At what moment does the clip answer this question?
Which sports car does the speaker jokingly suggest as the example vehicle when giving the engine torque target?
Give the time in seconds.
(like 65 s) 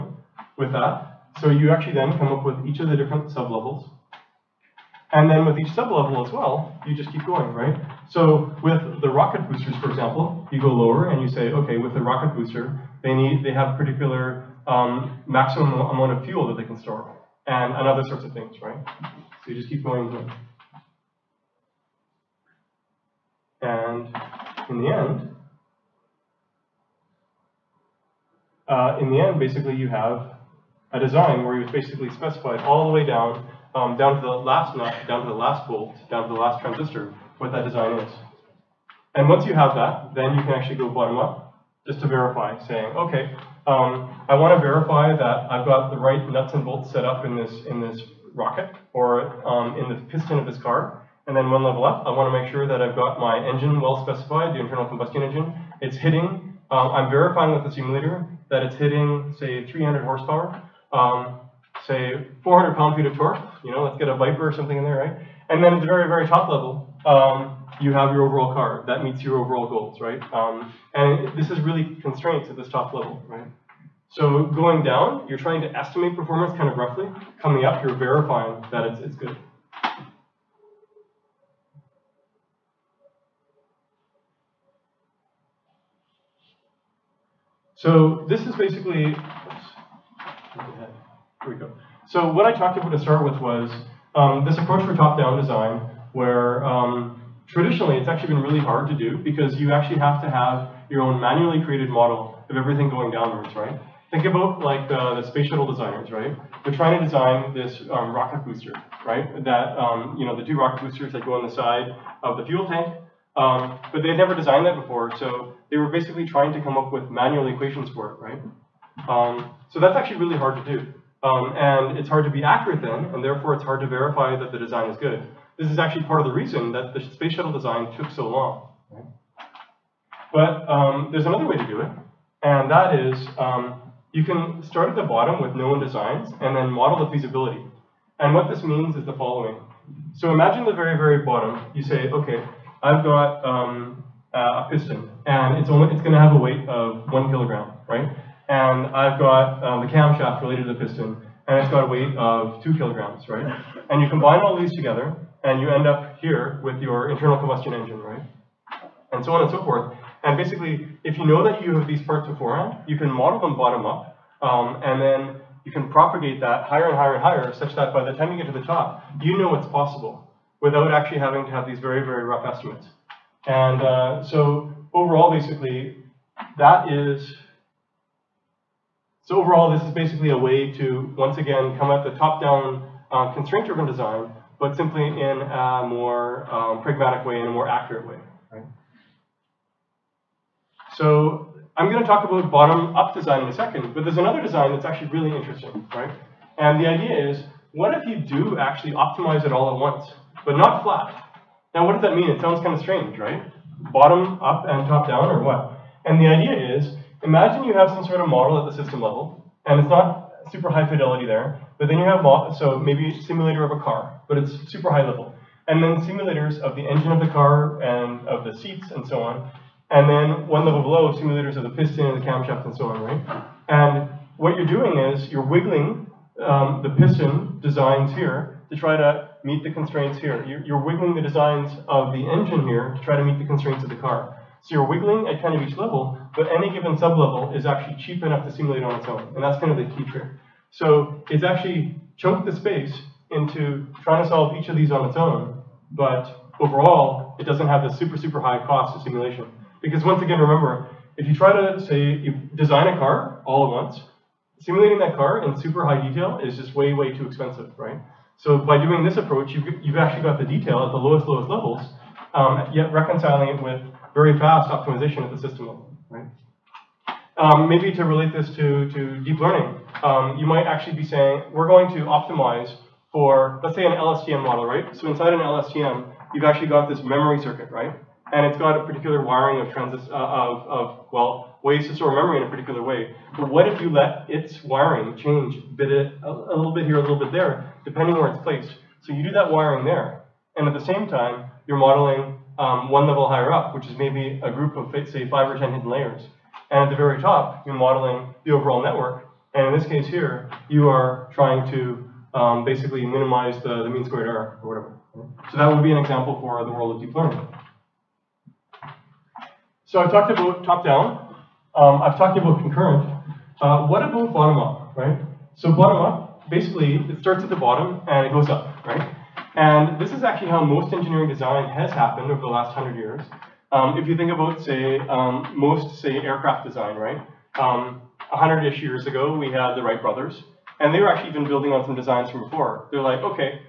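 64 s.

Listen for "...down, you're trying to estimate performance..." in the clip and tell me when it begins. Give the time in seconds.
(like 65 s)
74 s.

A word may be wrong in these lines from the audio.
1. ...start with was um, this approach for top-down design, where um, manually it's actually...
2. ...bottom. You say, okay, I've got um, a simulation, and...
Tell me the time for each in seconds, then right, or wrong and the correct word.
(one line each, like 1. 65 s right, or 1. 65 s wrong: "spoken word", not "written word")
1. 92 s wrong: "traditionally", not "manually"
2. 141 s wrong: "piston", not "simulation".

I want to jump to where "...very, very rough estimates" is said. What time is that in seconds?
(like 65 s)
171 s.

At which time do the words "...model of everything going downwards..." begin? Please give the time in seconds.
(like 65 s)
101 s.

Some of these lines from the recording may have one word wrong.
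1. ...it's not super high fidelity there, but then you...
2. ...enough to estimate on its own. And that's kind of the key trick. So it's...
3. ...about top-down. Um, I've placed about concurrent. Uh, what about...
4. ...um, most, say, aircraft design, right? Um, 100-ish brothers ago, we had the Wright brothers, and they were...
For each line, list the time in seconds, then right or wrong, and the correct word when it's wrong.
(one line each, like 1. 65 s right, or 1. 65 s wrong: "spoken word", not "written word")
1. 209 s right
2. 238 s wrong: "simulate", not "estimate"
3. 310 s wrong: "talked", not "placed"
4. 325 s wrong: "years", not "brothers".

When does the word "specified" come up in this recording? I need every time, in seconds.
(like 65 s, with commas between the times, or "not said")
32 s, 54 s.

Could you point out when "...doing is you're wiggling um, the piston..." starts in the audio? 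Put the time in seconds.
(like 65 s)
224 s.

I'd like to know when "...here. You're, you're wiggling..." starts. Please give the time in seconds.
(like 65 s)
230 s.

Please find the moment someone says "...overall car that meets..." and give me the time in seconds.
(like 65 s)
68 s.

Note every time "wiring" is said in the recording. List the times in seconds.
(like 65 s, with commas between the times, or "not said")
279 s, 284 s, 289 s.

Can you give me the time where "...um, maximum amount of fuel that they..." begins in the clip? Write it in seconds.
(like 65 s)
14 s.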